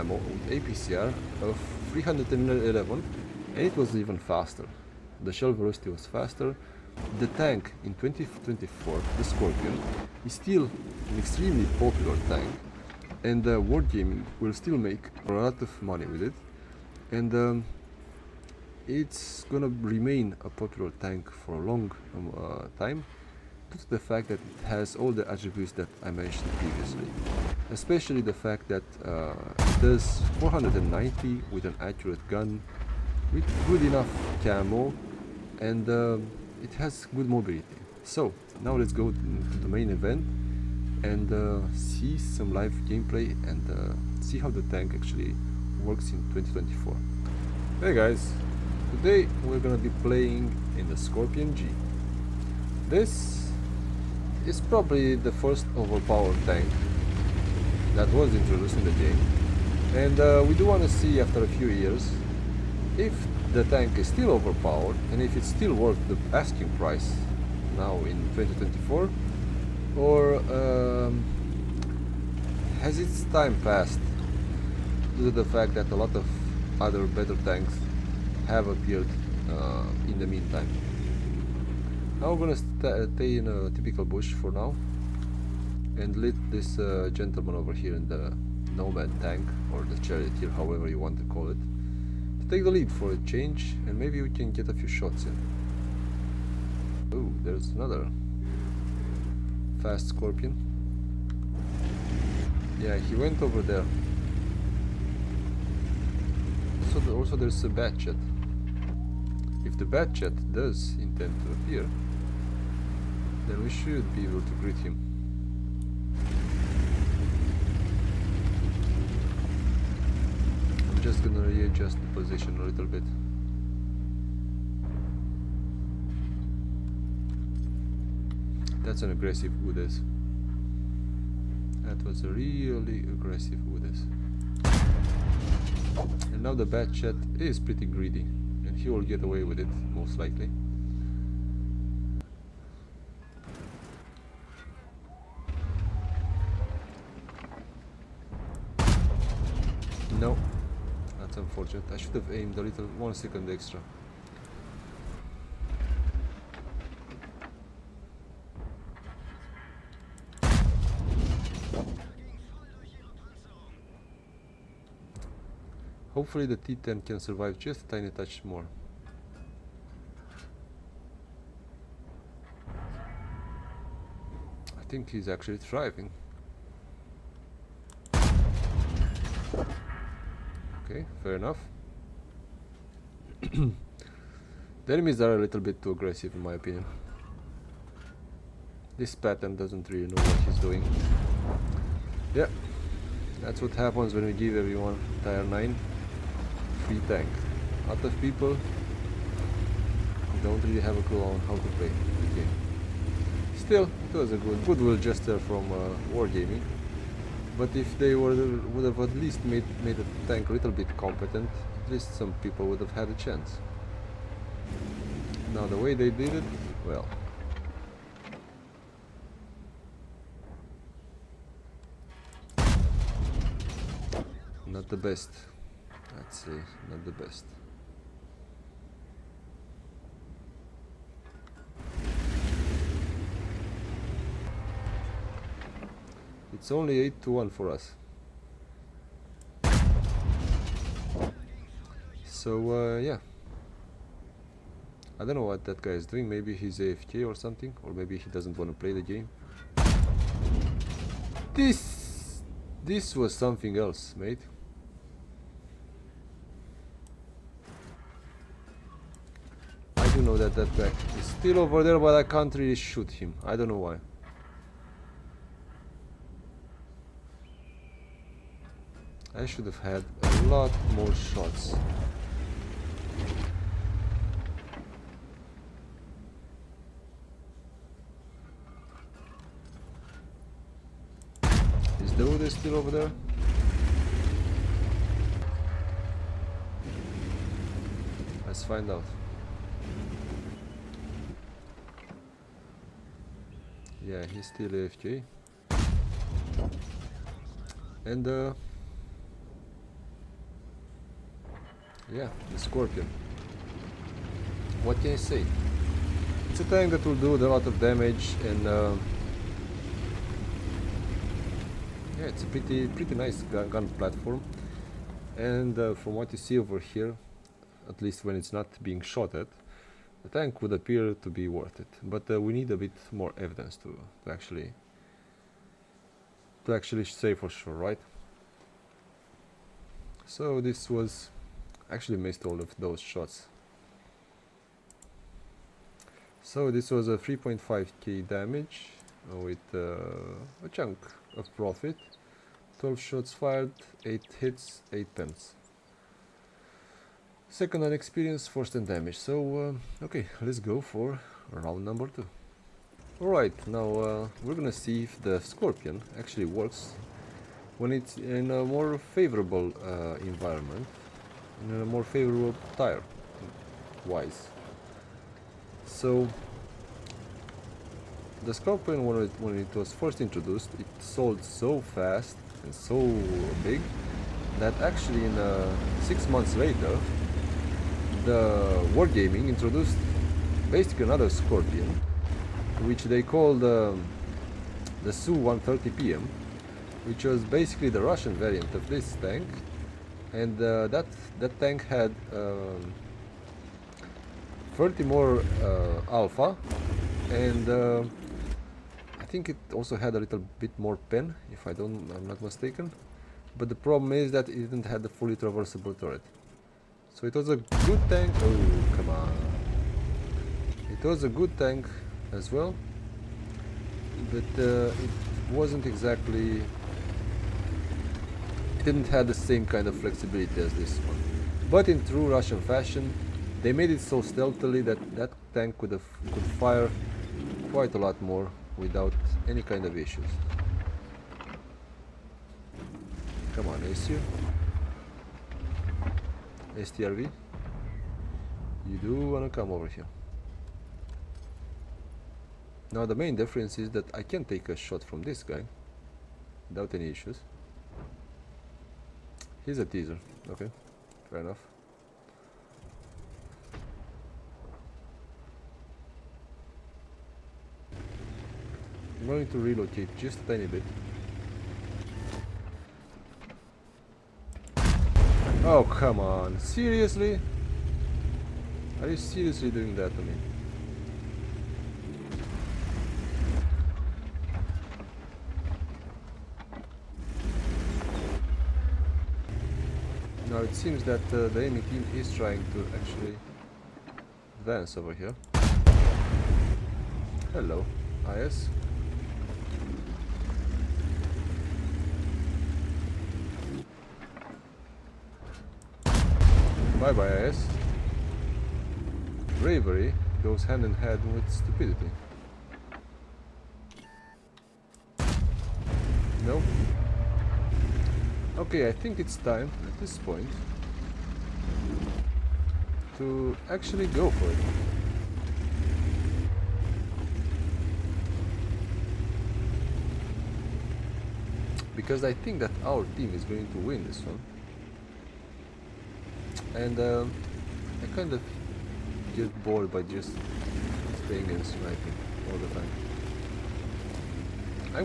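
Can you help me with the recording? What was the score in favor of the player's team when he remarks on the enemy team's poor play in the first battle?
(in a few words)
8 to 1.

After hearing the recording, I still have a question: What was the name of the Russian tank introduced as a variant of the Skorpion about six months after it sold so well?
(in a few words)
Su-130PM.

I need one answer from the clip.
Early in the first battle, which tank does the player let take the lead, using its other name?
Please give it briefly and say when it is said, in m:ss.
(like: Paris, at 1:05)
Nomad, at 1:28.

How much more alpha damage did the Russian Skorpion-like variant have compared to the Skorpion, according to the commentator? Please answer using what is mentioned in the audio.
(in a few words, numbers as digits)
30.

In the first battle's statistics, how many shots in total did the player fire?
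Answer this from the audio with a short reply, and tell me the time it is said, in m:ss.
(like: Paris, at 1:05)
12, at 5:42.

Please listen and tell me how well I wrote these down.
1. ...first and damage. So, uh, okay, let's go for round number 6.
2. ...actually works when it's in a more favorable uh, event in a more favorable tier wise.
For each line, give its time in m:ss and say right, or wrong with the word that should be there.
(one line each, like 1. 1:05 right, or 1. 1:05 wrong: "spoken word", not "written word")
1. 5:48 wrong: "2", not "6"
2. 5:56 wrong: "environment", not "event".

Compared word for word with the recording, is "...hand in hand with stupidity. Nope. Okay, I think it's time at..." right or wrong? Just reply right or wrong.
right.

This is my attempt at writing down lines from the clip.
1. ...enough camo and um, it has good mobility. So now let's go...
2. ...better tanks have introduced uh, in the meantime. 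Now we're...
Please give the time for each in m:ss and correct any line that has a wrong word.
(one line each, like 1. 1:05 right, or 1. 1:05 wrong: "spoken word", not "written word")
1. 0:33 right
2. 1:17 wrong: "appeared", not "introduced".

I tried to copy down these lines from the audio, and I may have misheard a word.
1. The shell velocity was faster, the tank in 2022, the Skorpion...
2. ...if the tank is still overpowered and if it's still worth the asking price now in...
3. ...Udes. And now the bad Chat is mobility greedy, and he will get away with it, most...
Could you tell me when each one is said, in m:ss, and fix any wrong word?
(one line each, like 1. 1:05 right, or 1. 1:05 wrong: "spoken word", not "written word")
1. 0:05 wrong: "2024", not "2022"
2. 1:02 right
3. 2:13 wrong: "pretty", not "mobility".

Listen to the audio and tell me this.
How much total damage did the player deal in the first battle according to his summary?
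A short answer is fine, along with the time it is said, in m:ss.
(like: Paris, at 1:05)
3.5k, at 5:37.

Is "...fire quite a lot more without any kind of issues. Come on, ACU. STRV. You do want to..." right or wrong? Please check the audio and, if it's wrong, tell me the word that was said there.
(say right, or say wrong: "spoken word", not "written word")
right.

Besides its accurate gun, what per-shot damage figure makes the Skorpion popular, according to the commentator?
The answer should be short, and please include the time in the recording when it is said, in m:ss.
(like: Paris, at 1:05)
490, at 0:30.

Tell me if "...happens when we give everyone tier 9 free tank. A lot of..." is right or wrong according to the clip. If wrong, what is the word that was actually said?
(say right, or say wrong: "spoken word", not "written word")
right.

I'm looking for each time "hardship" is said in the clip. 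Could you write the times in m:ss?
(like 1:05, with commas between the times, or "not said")
not said.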